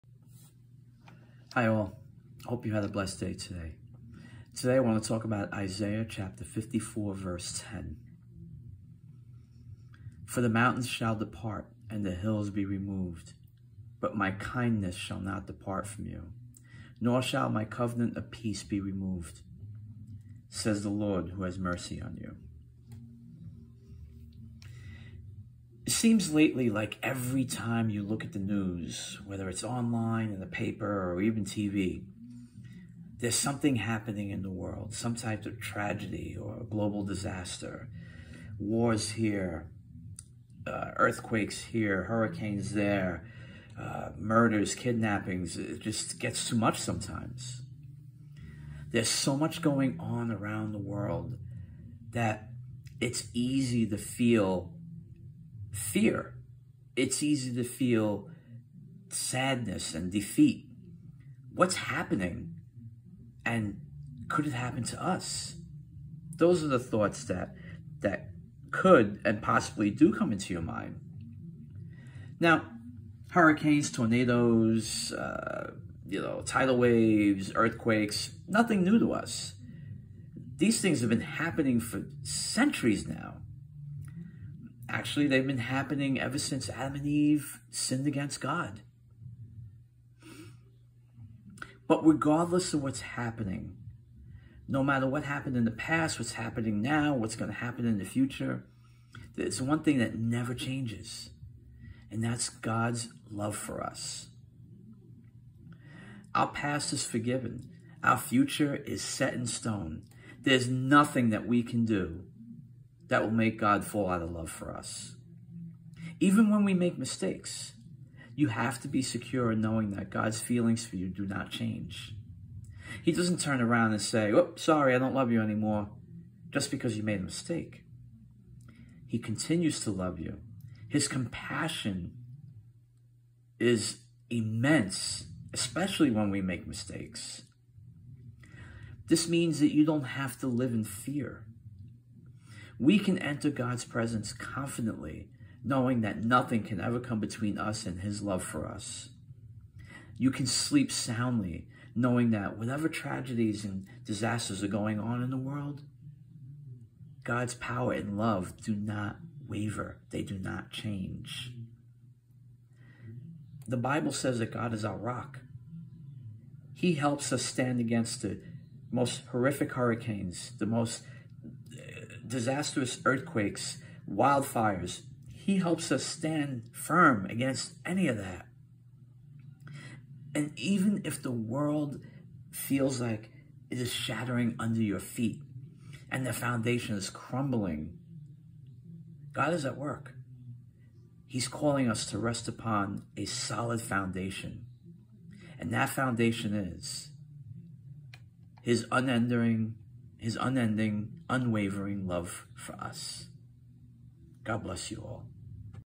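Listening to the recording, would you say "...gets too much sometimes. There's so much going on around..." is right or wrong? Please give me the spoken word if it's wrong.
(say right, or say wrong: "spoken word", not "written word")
right.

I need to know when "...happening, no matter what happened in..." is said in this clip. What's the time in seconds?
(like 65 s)
93 s.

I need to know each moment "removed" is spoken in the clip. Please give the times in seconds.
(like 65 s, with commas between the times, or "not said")
12 s, 18 s.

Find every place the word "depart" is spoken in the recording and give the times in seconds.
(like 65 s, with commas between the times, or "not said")
11 s, 15 s.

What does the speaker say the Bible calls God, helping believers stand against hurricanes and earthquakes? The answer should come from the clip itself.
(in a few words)
Our rock.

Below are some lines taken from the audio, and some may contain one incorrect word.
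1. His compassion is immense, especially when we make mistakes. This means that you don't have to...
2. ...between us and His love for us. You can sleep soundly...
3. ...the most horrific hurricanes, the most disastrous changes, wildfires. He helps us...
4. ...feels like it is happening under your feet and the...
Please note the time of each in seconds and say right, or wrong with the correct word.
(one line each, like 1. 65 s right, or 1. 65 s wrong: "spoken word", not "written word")
1. 130 s right
2. 147 s right
3. 168 s wrong: "earthquakes", not "changes"
4. 182 s wrong: "shattering", not "happening".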